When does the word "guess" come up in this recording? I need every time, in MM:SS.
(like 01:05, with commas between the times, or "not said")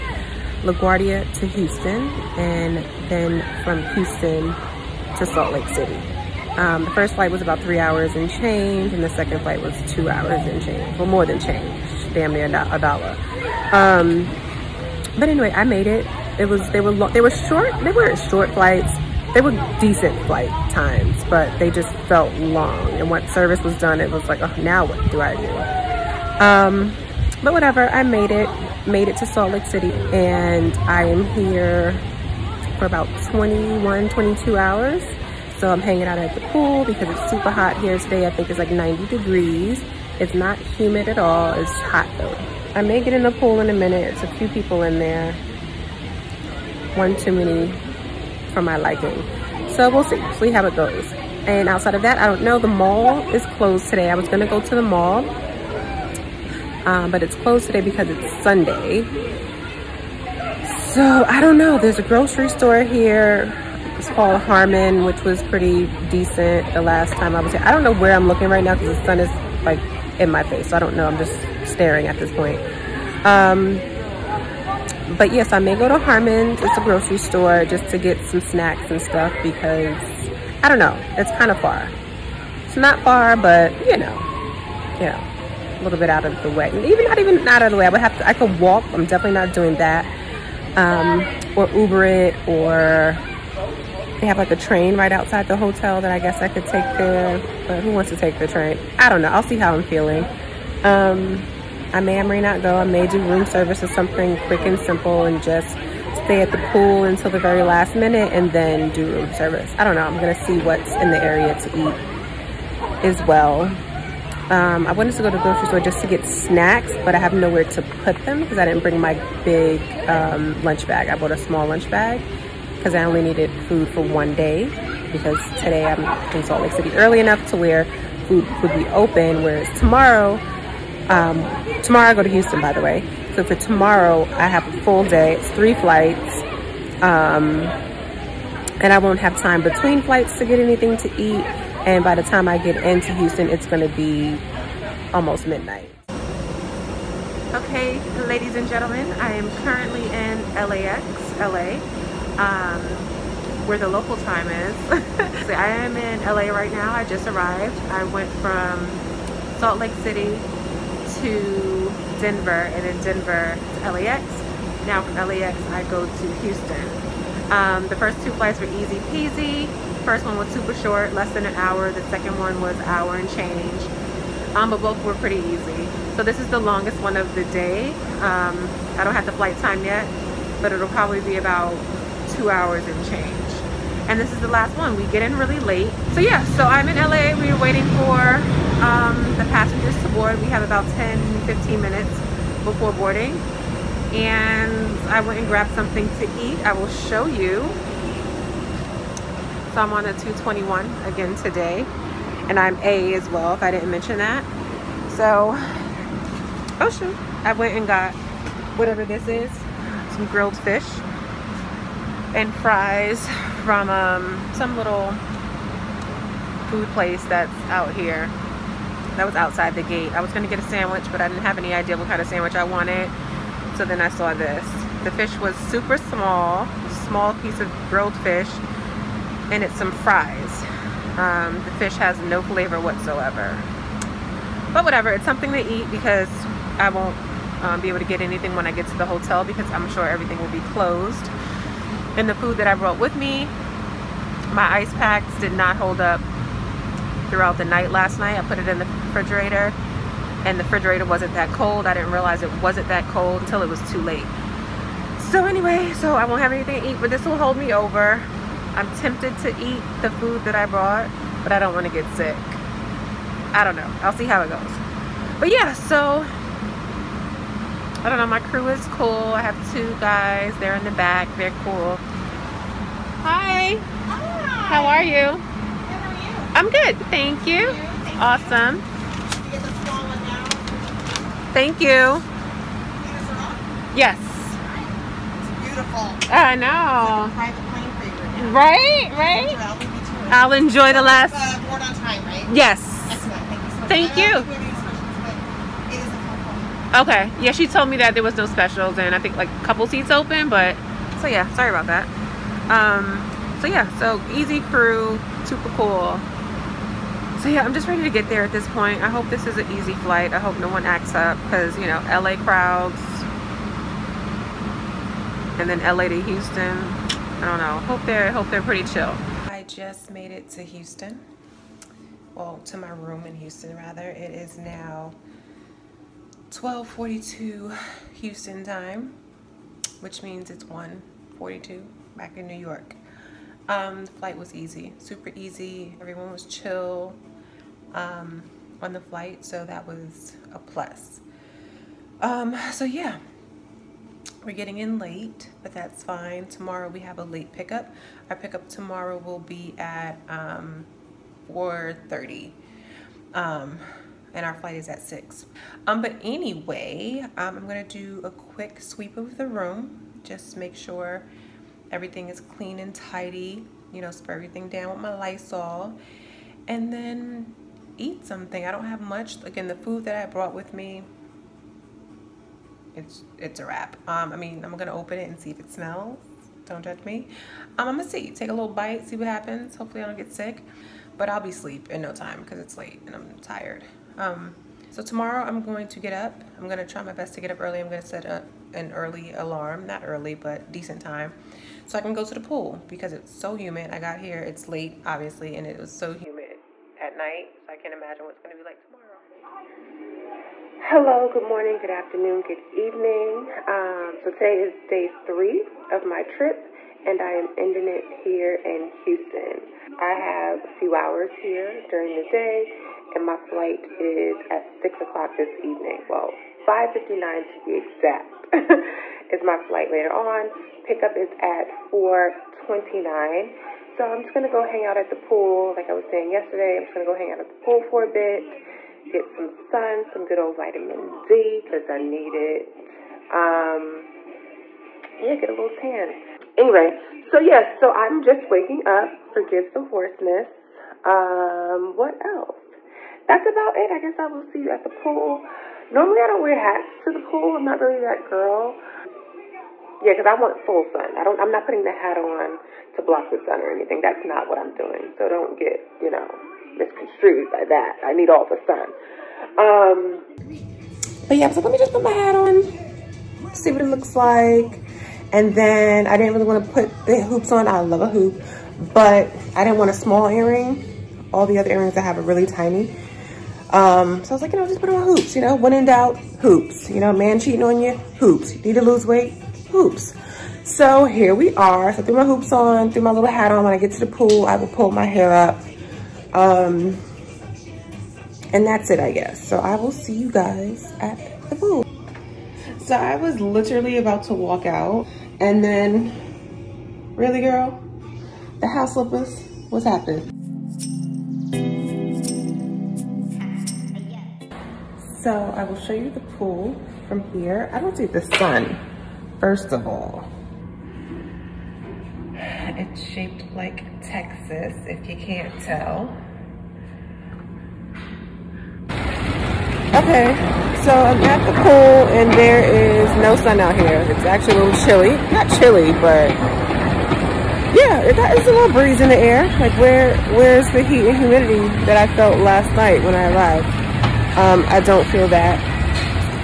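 01:36, 07:23, 08:09.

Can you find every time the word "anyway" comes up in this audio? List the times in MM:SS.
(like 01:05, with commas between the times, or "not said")
00:15, 04:15, 05:56, 07:16.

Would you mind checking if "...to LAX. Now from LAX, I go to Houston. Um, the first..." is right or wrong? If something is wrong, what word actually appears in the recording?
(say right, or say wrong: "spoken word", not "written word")
right.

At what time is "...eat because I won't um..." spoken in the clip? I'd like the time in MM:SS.
03:55.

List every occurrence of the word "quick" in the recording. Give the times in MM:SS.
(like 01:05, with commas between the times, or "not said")
01:44, 05:58.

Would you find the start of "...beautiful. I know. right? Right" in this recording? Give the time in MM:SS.
04:45.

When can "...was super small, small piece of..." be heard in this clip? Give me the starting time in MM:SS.
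03:45.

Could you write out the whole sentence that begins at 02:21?
And by the time I get into Houston, it's going to be almost midnight.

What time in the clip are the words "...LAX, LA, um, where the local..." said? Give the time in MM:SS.
02:30.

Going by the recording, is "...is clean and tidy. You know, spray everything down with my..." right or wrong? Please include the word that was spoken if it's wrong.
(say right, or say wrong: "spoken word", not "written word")
right.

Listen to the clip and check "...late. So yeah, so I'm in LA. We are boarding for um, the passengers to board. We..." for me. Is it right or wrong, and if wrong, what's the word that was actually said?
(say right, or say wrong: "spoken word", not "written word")
wrong: "waiting", not "boarding".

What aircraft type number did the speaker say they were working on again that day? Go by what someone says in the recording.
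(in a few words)
221.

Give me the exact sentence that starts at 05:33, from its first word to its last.
Um, the flight was easy, super easy.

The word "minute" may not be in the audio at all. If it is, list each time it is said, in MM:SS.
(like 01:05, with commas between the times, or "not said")
00:43, 01:47, 03:11.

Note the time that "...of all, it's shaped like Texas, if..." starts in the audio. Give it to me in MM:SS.
08:29.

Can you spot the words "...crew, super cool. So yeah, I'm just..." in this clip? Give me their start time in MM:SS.
05:04.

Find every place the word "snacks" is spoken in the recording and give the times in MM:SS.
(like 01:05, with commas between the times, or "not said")
01:18, 01:56.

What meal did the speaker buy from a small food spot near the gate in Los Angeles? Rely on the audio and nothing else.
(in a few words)
Grilled fish and fries.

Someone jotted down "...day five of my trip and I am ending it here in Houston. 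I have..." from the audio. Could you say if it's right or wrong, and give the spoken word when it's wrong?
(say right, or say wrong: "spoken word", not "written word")
wrong: "three", not "five".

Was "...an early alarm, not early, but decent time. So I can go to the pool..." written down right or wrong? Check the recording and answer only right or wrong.
right.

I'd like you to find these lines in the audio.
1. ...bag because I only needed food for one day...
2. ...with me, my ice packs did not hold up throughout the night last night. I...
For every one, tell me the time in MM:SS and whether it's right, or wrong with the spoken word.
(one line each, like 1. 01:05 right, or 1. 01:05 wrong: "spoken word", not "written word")
1. 02:01 right
2. 04:02 right.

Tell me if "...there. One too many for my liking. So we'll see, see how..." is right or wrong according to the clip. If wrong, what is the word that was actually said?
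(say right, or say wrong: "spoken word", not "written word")
right.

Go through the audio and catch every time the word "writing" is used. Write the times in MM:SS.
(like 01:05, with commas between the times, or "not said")
not said.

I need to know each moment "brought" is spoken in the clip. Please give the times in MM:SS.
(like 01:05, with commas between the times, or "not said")
04:02, 04:20, 06:10.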